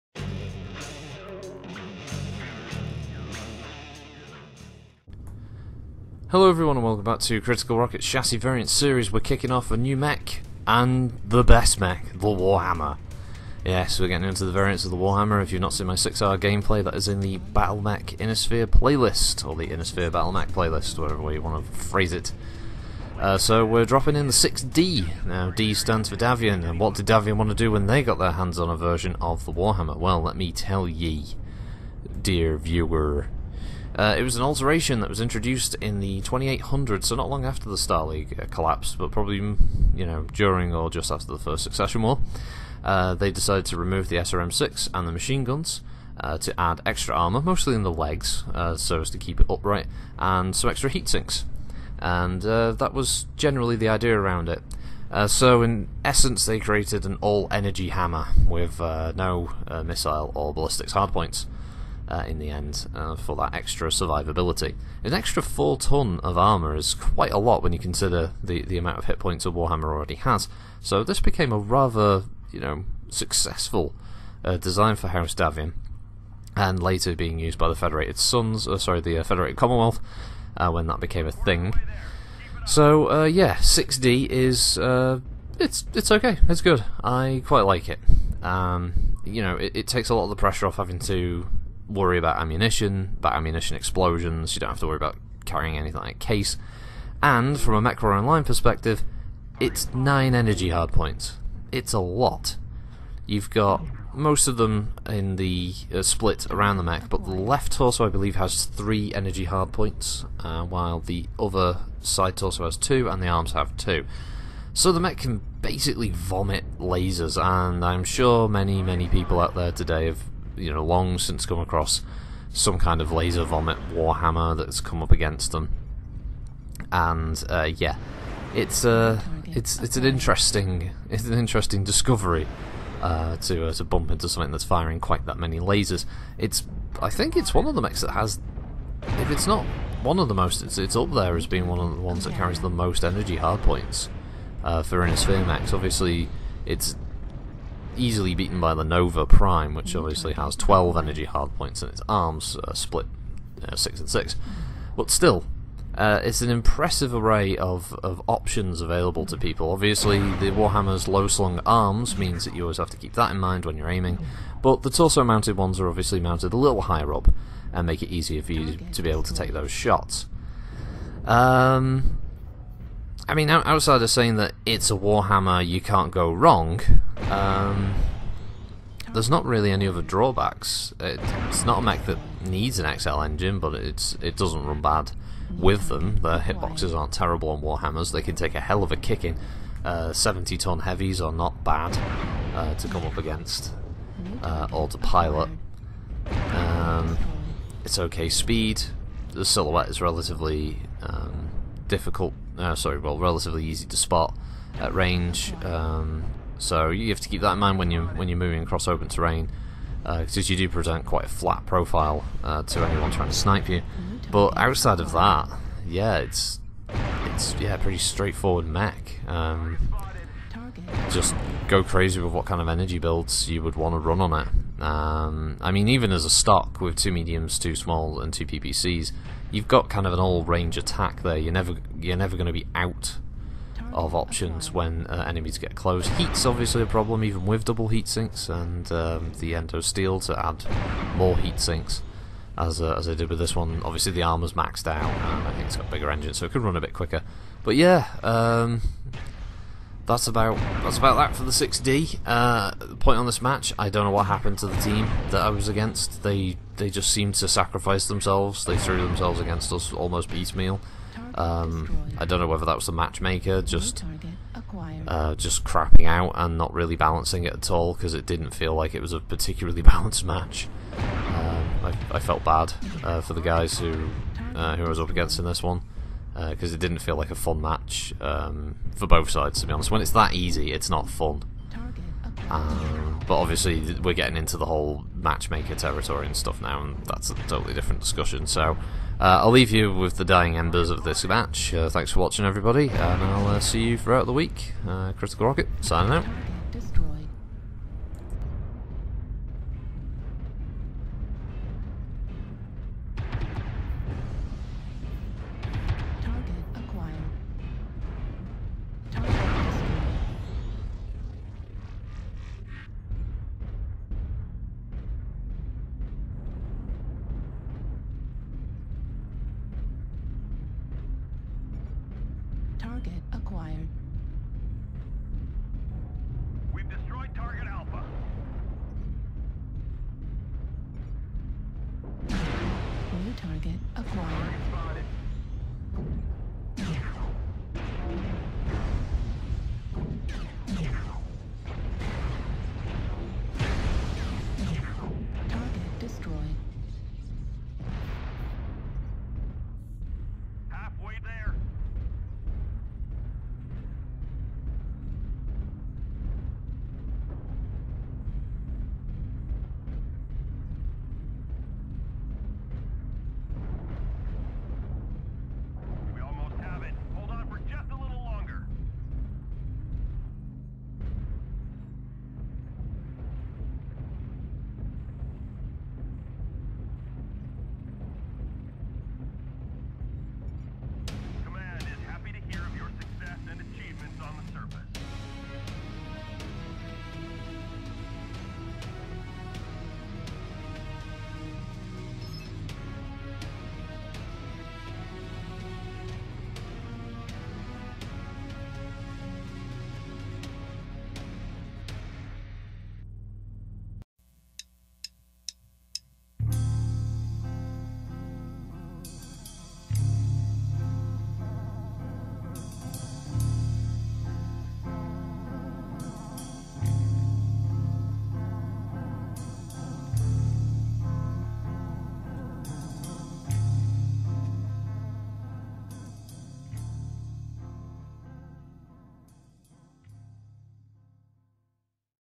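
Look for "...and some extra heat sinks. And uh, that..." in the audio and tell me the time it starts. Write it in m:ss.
0:50.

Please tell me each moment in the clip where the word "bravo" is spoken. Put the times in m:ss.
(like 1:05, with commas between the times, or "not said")
not said.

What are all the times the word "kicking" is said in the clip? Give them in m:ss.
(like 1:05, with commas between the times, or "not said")
0:09, 3:08.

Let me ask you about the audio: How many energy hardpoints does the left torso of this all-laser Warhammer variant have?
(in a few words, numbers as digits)
3.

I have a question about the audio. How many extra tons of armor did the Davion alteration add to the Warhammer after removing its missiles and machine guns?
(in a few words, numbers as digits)
4.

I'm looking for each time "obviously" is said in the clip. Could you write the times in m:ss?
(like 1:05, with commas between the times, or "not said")
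2:25, 2:29, 2:39, 2:45, 3:56, 4:03, 4:43.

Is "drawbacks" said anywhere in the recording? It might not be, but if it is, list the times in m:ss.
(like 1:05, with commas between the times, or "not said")
3:00.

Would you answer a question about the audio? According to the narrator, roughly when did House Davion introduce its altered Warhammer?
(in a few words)
2800s.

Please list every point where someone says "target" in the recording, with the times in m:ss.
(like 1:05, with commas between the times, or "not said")
5:27, 5:33.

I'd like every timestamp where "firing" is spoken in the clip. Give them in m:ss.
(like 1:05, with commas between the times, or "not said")
2:14.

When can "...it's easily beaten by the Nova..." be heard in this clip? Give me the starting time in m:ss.
2:26.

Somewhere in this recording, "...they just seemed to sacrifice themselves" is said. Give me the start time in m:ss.
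4:16.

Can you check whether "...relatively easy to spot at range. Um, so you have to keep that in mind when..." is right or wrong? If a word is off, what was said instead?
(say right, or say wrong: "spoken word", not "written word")
right.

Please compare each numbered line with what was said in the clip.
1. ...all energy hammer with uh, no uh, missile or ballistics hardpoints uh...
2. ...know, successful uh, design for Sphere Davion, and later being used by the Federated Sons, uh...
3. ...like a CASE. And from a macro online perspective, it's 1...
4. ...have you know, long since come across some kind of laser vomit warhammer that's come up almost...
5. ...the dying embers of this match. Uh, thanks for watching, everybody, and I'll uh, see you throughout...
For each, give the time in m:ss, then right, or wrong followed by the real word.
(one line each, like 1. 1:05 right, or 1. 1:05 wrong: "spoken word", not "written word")
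1. 0:57 right
2. 1:12 wrong: "House", not "Sphere"
3. 1:36 wrong: "9", not "1"
4. 2:00 wrong: "against", not "almost"
5. 4:50 right.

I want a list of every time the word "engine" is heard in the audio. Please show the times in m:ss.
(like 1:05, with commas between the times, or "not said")
3:03, 4:06.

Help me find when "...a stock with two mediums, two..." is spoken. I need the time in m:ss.
3:46.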